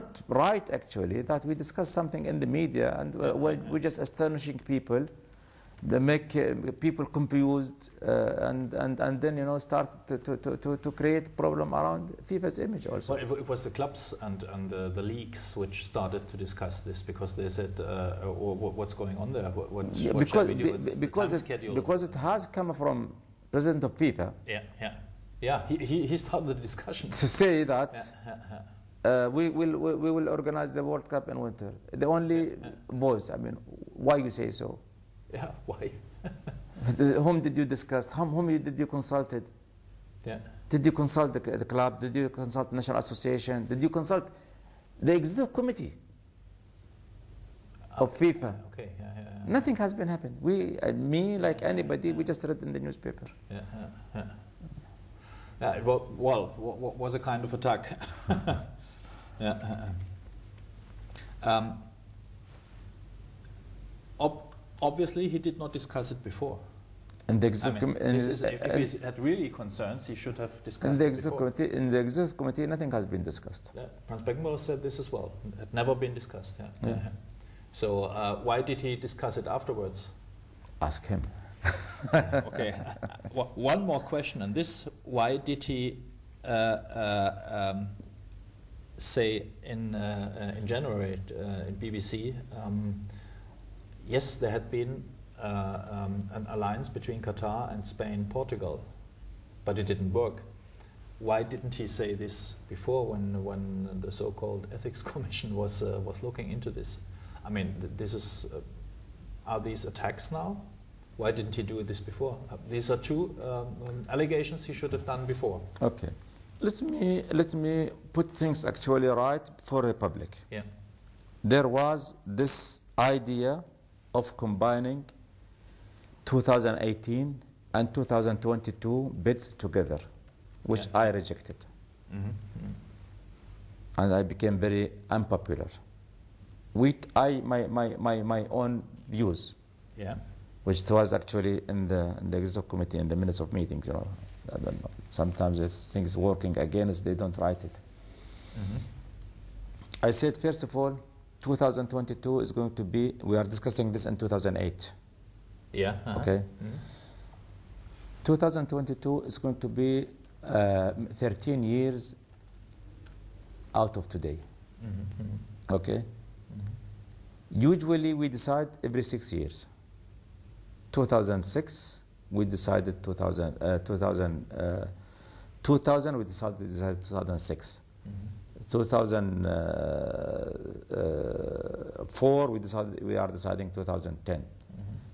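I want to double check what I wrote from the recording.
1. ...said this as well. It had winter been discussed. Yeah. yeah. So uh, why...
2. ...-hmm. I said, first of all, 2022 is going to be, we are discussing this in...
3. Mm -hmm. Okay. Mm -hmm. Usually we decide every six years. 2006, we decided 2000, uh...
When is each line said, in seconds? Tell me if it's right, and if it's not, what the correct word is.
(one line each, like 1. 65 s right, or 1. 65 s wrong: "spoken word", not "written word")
1. 74 s wrong: "never", not "winter"
2. 148 s right
3. 164 s right.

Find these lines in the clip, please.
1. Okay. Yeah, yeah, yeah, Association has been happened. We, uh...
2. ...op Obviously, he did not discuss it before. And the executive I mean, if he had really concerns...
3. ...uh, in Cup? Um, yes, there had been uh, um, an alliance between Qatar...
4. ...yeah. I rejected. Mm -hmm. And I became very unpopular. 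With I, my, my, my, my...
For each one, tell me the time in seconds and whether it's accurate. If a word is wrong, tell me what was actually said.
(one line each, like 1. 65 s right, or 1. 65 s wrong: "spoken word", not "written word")
1. 48 s wrong: "Nothing", not "Association"
2. 64 s right
3. 91 s wrong: "BBC", not "Cup"
4. 130 s right.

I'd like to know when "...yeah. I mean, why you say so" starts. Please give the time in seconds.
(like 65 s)
33 s.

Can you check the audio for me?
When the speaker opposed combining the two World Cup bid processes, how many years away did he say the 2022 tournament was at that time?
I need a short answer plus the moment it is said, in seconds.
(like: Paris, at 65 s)
13, at 161 s.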